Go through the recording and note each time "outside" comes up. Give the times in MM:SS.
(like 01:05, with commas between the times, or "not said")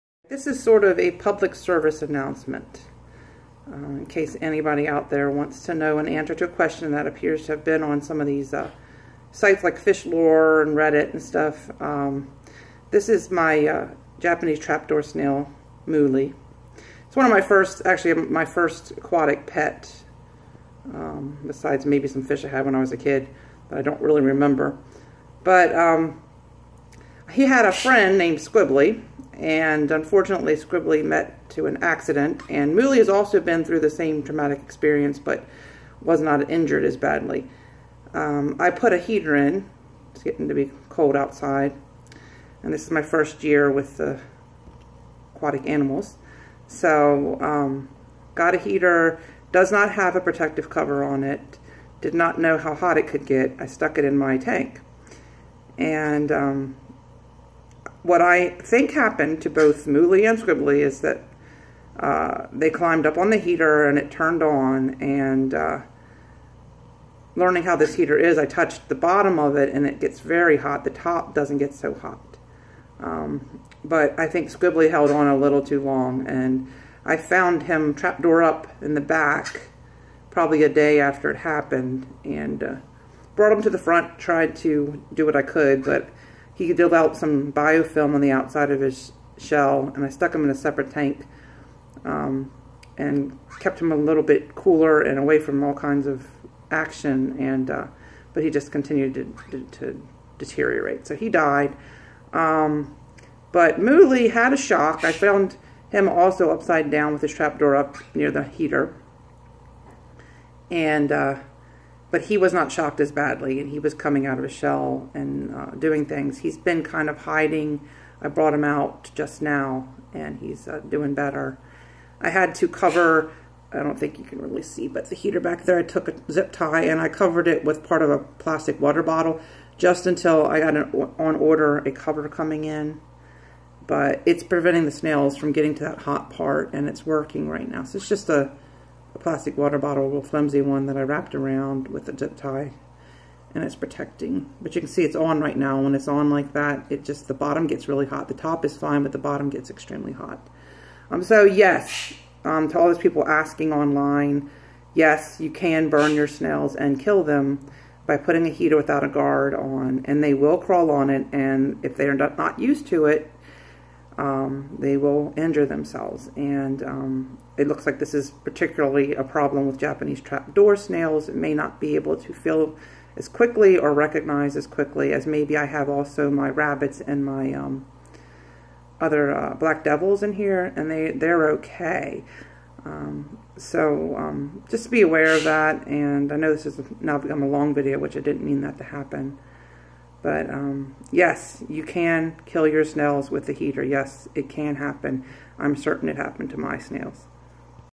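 00:41, 01:28.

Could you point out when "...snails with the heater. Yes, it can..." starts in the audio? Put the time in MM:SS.
03:12.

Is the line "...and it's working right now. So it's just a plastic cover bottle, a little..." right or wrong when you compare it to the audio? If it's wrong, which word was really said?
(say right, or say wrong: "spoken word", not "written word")
wrong: "water", not "cover".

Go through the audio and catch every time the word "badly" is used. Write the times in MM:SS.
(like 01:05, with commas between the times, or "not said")
00:36, 01:53.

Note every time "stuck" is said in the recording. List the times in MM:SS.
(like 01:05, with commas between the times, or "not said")
00:53, 01:30.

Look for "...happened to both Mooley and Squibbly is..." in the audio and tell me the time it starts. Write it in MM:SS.
00:58.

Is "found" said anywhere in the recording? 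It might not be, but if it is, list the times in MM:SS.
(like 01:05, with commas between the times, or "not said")
01:17, 01:45.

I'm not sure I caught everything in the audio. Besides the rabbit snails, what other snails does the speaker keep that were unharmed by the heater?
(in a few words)
black devils.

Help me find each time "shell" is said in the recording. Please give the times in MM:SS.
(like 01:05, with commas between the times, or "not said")
01:29, 01:54.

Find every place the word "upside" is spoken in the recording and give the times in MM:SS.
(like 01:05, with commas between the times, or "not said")
01:46.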